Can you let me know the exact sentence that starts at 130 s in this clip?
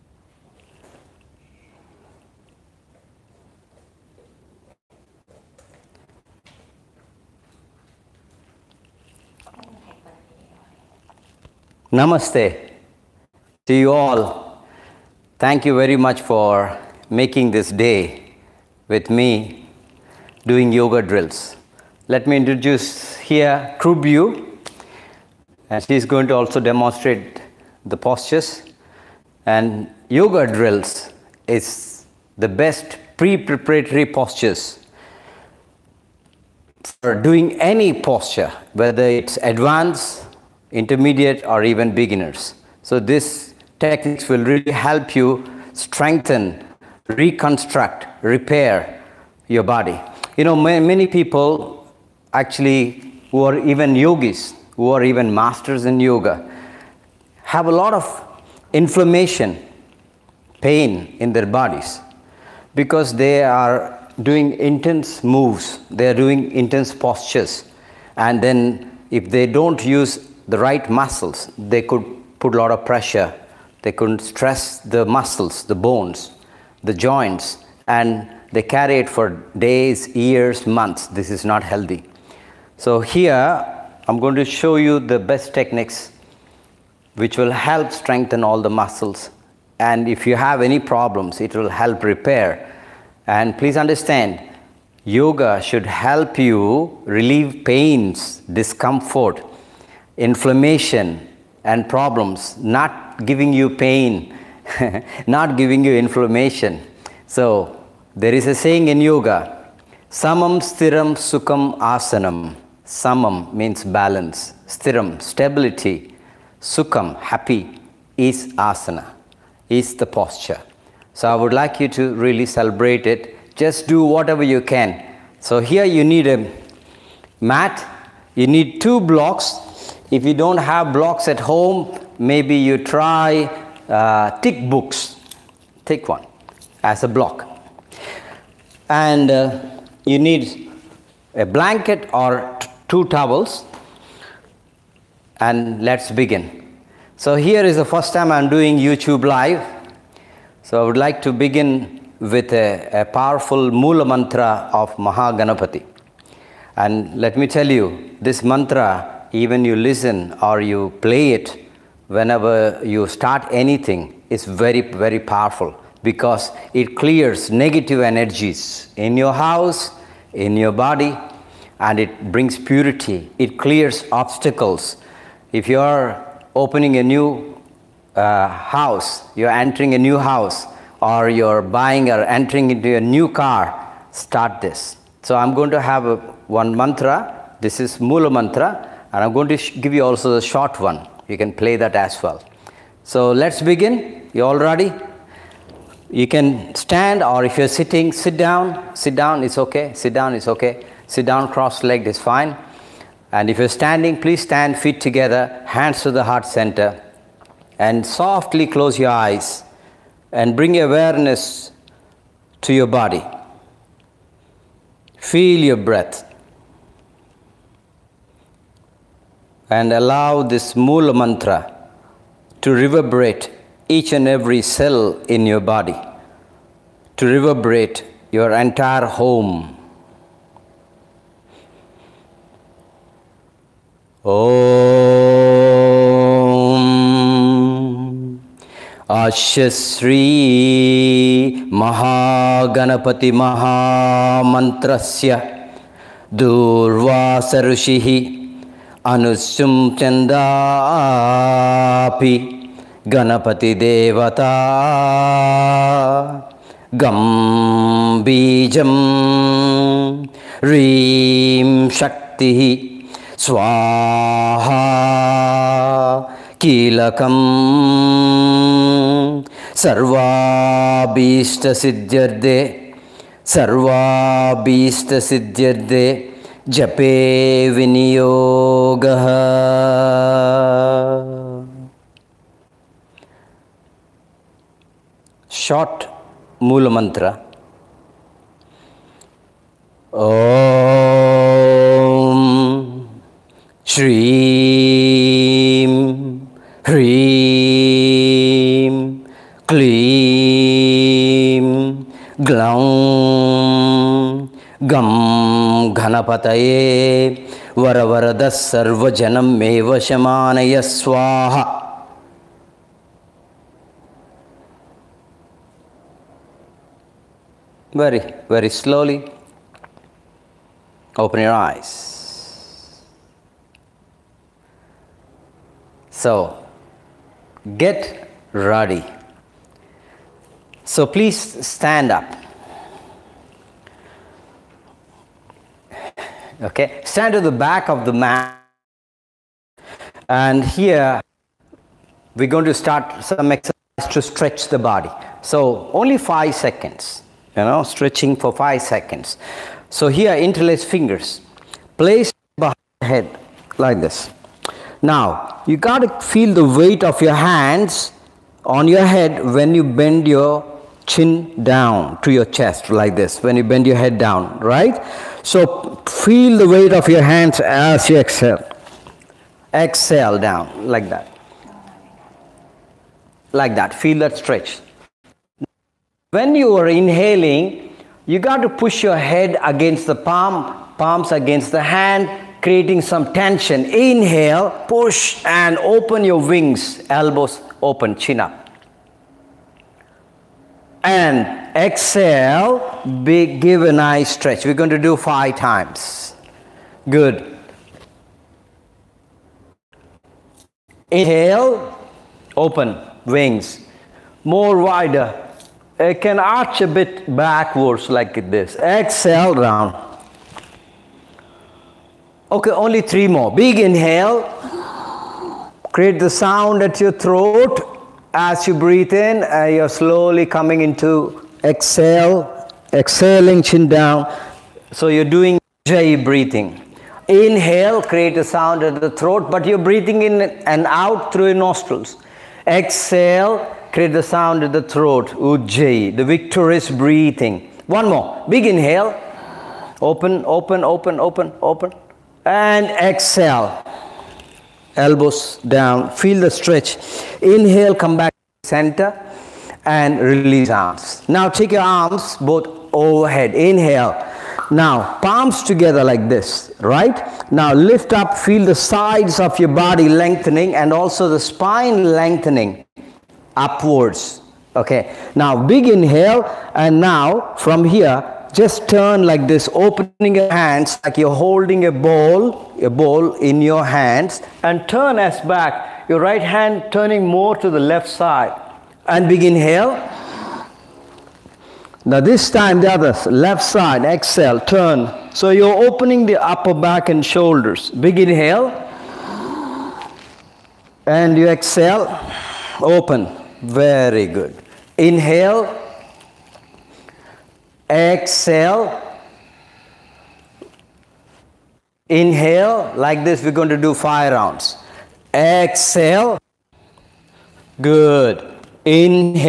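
If you don't have blocks at home, maybe you try uh, thick books.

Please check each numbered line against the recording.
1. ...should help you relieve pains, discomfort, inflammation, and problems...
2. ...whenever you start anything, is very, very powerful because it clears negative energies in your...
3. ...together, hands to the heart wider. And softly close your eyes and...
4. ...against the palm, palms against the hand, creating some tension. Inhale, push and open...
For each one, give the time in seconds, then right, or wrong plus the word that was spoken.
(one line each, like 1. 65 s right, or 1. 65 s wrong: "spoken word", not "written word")
1. 95 s right
2. 162 s right
3. 205 s wrong: "center", not "wider"
4. 379 s right.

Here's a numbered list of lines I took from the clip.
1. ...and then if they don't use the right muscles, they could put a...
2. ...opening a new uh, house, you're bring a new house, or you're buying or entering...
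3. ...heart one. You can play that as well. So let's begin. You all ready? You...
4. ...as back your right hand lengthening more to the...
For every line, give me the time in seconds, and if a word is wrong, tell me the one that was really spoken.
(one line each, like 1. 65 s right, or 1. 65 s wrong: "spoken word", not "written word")
1. 68 s right
2. 176 s wrong: "entering", not "bring"
3. 190 s wrong: "short", not "heart"
4. 475 s wrong: "turning", not "lengthening".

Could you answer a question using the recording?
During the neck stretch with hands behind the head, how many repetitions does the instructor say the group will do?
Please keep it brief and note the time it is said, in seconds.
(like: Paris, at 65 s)
5, at 395 s.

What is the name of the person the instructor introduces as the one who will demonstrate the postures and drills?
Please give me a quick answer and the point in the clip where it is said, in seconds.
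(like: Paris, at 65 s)
Krubyu, at 23 s.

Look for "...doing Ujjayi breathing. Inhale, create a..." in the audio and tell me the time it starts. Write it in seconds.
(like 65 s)
425 s.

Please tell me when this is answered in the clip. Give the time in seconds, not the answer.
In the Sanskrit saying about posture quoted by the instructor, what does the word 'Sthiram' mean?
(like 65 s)
115 s.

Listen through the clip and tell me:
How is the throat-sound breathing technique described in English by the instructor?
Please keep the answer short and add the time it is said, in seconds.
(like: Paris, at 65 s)
the victorious breathing, at 436 s.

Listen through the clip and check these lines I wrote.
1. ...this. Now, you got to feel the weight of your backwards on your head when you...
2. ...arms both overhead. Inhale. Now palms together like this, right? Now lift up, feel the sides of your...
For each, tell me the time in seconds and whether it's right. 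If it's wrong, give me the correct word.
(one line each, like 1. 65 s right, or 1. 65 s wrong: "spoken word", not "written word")
1. 354 s wrong: "hands", not "backwards"
2. 451 s right.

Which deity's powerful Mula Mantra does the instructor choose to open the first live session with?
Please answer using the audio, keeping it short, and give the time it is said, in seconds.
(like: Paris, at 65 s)
Mahaganapati, at 154 s.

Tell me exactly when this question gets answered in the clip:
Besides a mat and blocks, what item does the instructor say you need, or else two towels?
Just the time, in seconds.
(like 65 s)
141 s.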